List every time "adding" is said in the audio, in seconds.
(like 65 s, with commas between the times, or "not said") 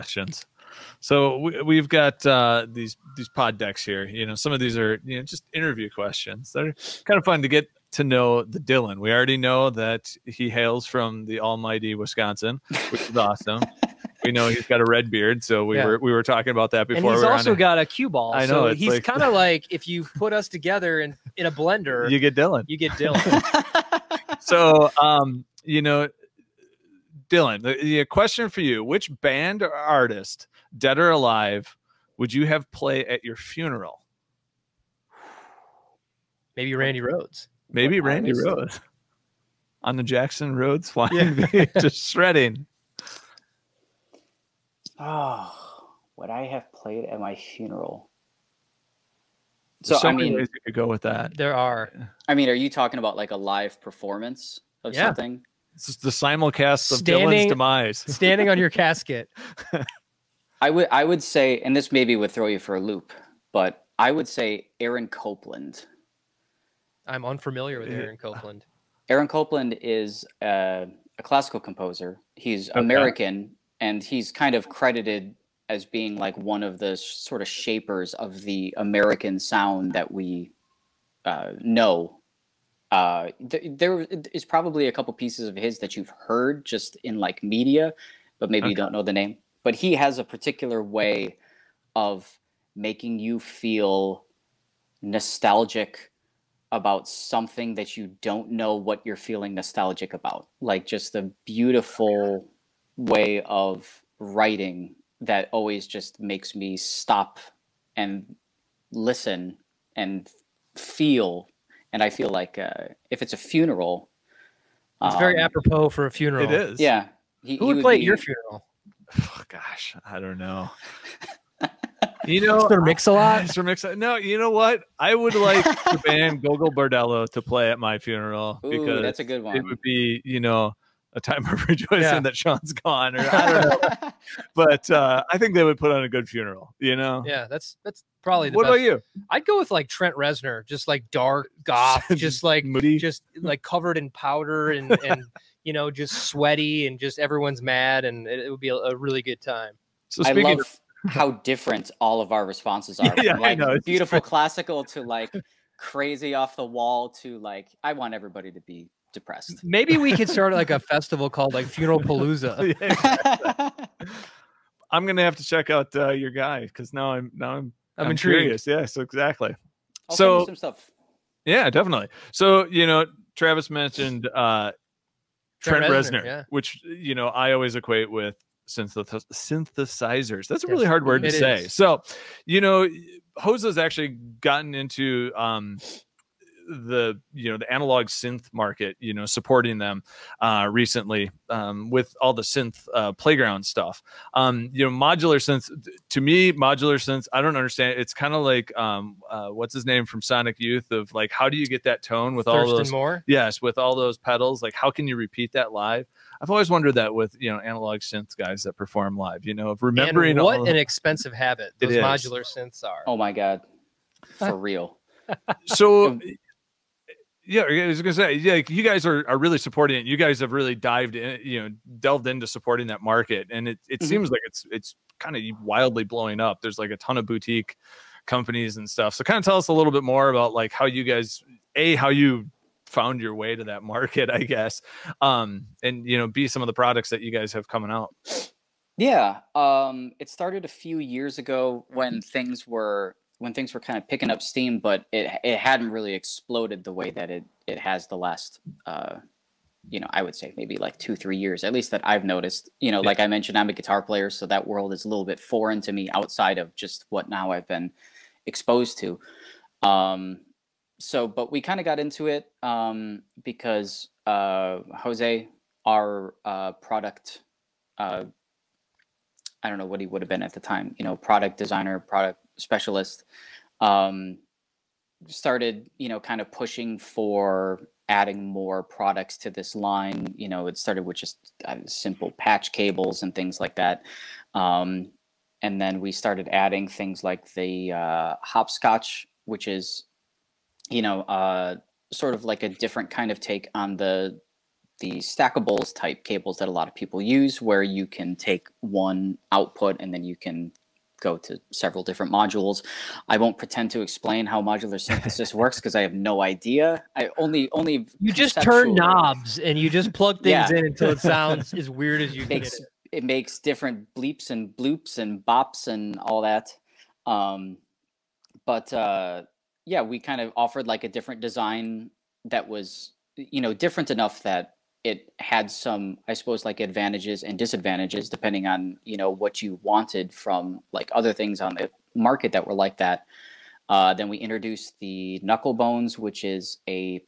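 278 s, 286 s.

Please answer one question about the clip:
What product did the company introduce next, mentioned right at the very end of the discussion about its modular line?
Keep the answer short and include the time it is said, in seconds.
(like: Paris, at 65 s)
Knuckle bones, at 335 s.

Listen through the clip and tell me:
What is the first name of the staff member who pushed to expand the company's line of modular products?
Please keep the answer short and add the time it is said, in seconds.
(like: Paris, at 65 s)
Jose, at 264 s.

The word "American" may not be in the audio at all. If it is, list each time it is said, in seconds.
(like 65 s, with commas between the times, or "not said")
72 s, 78 s.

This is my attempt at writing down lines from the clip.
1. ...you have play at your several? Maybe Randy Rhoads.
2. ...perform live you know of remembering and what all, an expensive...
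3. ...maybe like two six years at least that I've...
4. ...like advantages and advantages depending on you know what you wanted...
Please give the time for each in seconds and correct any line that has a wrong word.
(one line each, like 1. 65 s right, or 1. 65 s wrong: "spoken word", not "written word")
1. 32 s wrong: "funeral", not "several"
2. 208 s right
3. 250 s wrong: "three", not "six"
4. 326 s wrong: "disadvantages", not "advantages".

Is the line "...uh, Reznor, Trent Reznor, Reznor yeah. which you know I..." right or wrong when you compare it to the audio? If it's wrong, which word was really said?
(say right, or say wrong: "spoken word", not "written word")
wrong: "Trent", not "Reznor".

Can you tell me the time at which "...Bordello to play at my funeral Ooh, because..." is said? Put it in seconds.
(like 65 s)
126 s.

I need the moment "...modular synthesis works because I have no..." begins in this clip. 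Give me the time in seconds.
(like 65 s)
304 s.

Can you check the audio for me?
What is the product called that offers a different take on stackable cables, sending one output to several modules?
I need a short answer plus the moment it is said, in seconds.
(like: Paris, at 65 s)
Hopscotch, at 288 s.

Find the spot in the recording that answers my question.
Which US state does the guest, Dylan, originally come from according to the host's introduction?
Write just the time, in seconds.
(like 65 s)
11 s.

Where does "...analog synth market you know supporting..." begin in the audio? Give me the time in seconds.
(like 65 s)
187 s.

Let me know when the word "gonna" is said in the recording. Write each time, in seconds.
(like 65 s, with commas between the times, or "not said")
165 s, 218 s.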